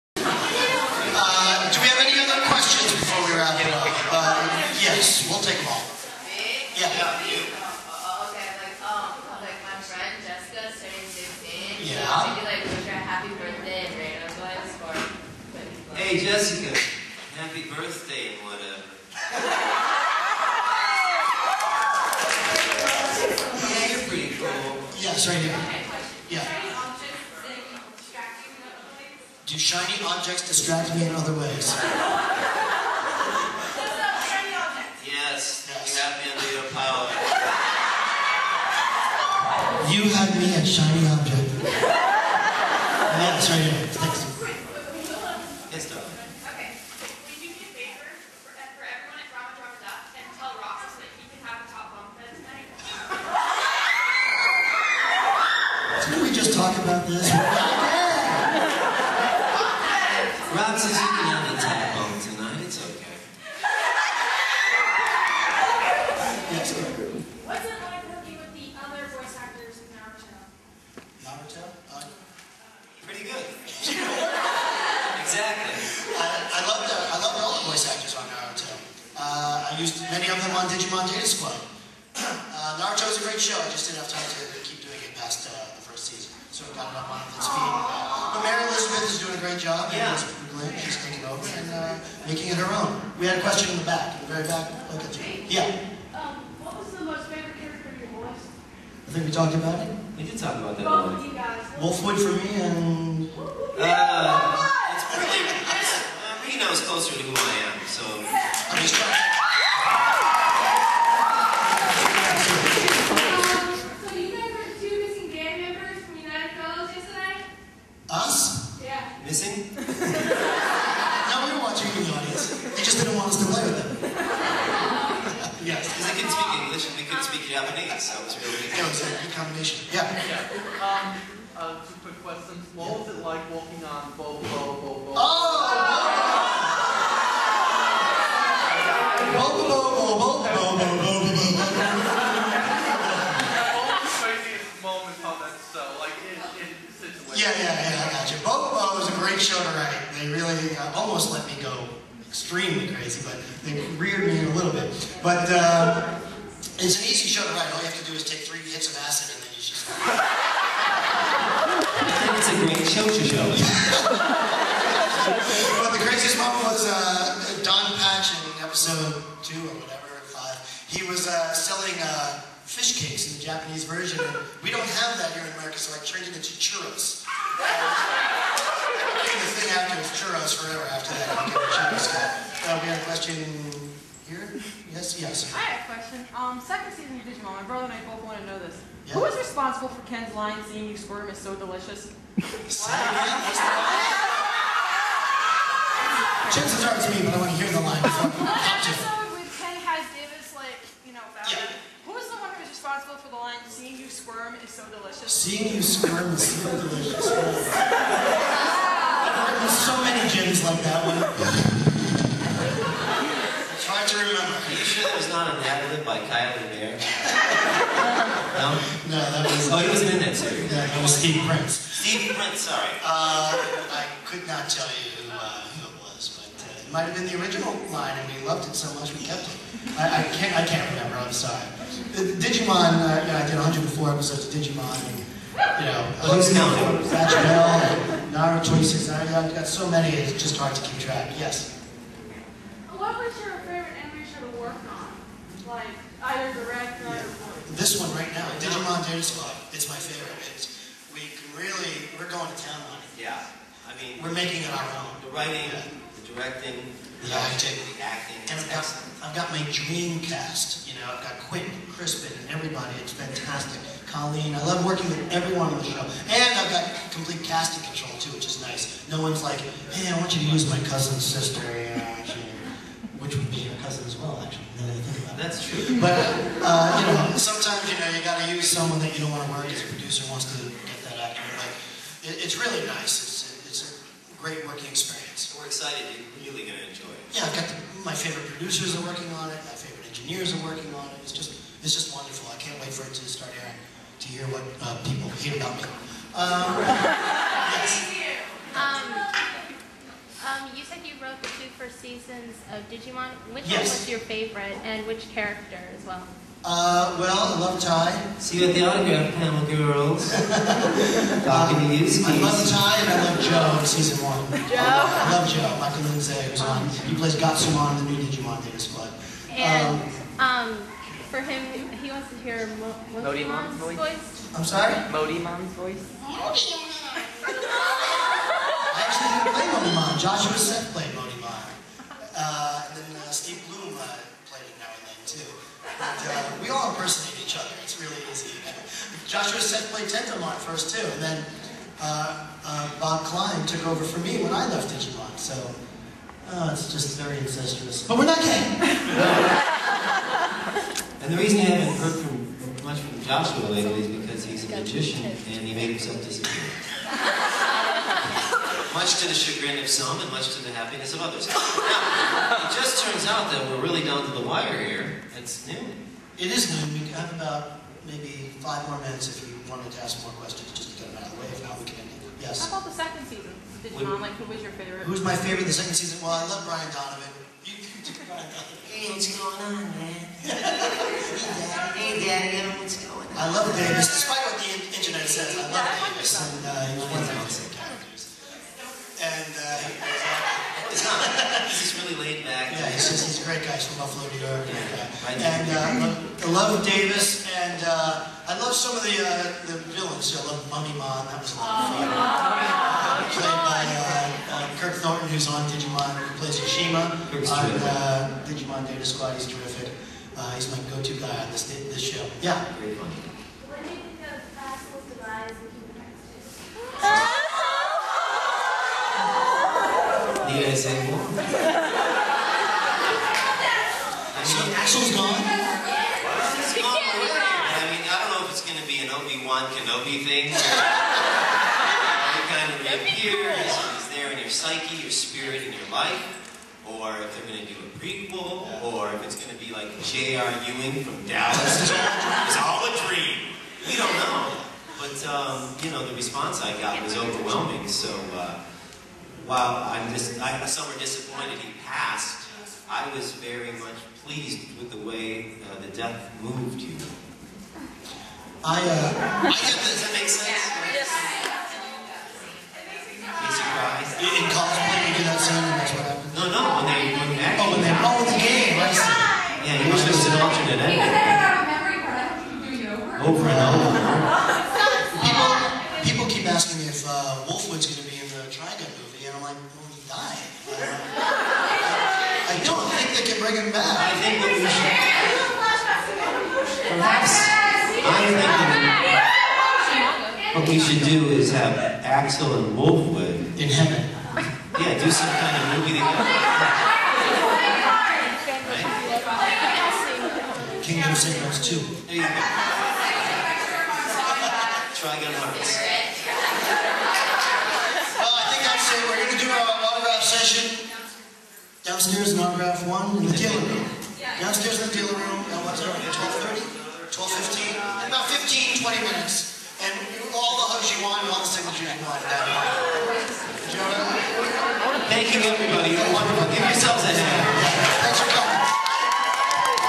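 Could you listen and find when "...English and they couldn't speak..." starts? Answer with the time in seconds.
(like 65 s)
126 s.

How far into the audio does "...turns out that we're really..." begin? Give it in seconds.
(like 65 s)
363 s.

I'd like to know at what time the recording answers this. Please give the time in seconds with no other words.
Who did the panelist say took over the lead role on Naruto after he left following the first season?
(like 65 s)
88 s.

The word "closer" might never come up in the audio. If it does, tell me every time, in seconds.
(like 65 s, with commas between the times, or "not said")
106 s.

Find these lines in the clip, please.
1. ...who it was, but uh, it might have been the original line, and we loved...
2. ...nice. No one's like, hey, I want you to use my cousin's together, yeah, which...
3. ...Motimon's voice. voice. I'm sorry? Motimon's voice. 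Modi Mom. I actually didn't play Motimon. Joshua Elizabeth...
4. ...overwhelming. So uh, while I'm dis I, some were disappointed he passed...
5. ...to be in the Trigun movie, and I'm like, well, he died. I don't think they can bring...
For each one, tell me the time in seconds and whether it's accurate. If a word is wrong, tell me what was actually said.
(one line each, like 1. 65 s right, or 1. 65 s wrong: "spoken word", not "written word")
1. 225 s right
2. 268 s wrong: "sister", not "together"
3. 323 s wrong: "Seth", not "Elizabeth"
4. 447 s right
5. 477 s right.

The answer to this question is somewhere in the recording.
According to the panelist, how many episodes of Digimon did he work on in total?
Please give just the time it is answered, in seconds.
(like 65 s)
233 s.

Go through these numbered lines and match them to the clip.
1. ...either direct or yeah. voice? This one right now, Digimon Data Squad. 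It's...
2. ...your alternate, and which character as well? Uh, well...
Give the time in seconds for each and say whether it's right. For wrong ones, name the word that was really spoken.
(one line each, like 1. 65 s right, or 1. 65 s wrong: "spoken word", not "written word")
1. 246 s right
2. 304 s wrong: "favorite", not "alternate".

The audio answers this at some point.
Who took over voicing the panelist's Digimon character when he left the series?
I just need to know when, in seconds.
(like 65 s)
342 s.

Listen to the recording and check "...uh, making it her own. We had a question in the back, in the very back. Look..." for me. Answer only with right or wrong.
right.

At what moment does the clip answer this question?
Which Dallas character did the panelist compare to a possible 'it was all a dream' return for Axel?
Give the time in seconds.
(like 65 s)
440 s.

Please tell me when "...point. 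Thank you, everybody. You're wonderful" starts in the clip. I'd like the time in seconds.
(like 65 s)
522 s.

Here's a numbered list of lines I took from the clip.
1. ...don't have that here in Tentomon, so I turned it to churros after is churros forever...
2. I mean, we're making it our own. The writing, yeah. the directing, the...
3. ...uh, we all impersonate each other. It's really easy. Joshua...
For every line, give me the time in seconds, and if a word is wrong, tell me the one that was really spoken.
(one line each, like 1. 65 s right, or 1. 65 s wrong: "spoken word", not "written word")
1. 174 s wrong: "America", not "Tentomon"
2. 253 s right
3. 336 s right.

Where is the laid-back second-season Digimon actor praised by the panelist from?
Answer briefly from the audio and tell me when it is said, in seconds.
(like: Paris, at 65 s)
Buffalo, New York, at 394 s.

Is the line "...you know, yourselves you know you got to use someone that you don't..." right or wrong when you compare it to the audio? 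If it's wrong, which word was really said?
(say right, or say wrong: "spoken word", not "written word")
wrong: "sometimes", not "yourselves".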